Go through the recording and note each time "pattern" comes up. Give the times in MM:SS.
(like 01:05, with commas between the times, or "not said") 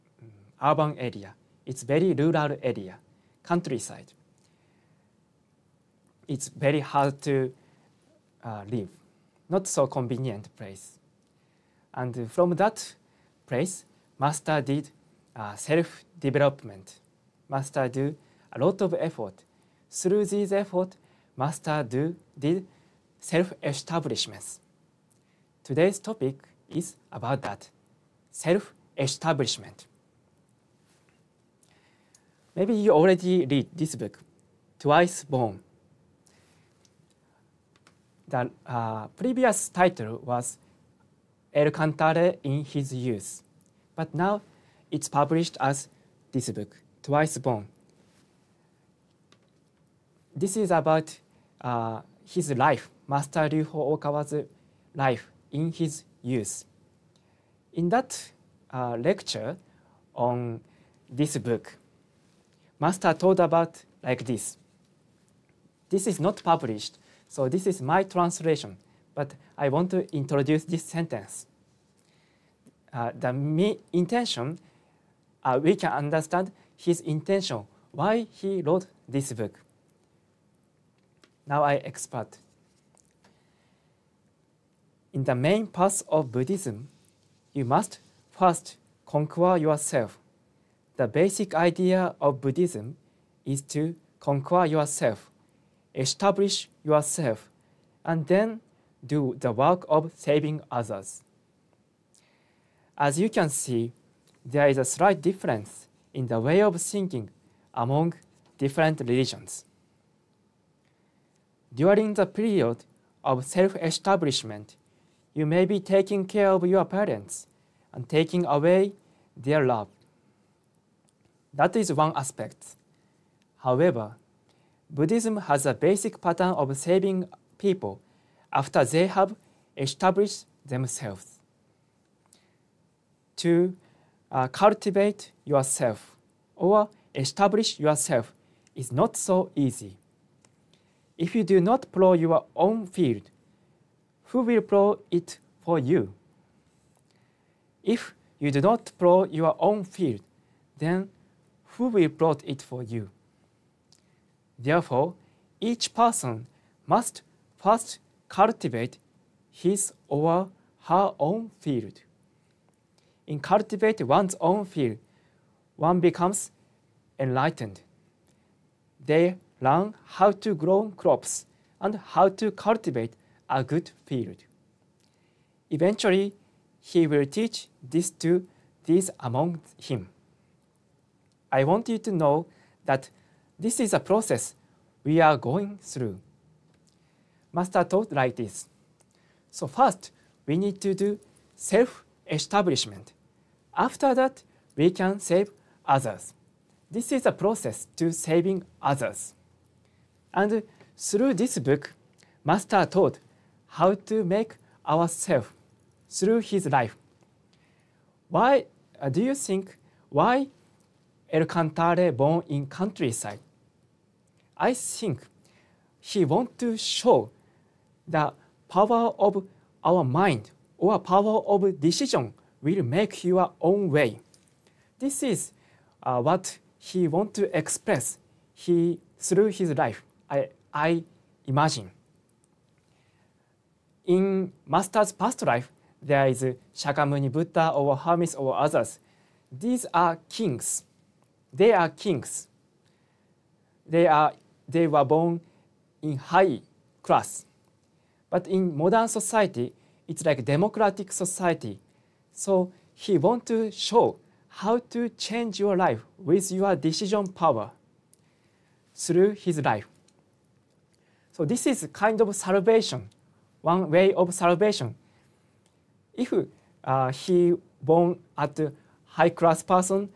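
02:06.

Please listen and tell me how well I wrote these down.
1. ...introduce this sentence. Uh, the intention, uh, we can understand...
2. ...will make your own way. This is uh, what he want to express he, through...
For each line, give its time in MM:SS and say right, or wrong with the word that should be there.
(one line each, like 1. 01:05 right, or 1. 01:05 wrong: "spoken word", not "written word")
1. 01:10 right
2. 03:42 right.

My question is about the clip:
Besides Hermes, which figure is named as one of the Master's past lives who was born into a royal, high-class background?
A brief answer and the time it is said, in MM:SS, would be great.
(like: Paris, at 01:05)
Shakyamuni Buddha, at 03:56.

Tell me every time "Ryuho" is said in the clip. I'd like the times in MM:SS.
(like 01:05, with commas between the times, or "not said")
00:53.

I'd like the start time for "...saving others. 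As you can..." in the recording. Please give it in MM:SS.
01:40.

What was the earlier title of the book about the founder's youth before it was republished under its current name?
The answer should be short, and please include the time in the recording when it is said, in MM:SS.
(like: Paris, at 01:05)
El Cantare in His Youth, at 00:41.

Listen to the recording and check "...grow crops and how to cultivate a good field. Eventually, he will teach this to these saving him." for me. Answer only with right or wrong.
wrong.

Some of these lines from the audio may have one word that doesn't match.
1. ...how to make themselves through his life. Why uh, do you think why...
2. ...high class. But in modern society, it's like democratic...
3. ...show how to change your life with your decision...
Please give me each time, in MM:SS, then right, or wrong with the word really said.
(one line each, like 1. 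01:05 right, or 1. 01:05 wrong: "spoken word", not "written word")
1. 03:23 wrong: "ourselves", not "themselves"
2. 04:06 right
3. 04:13 right.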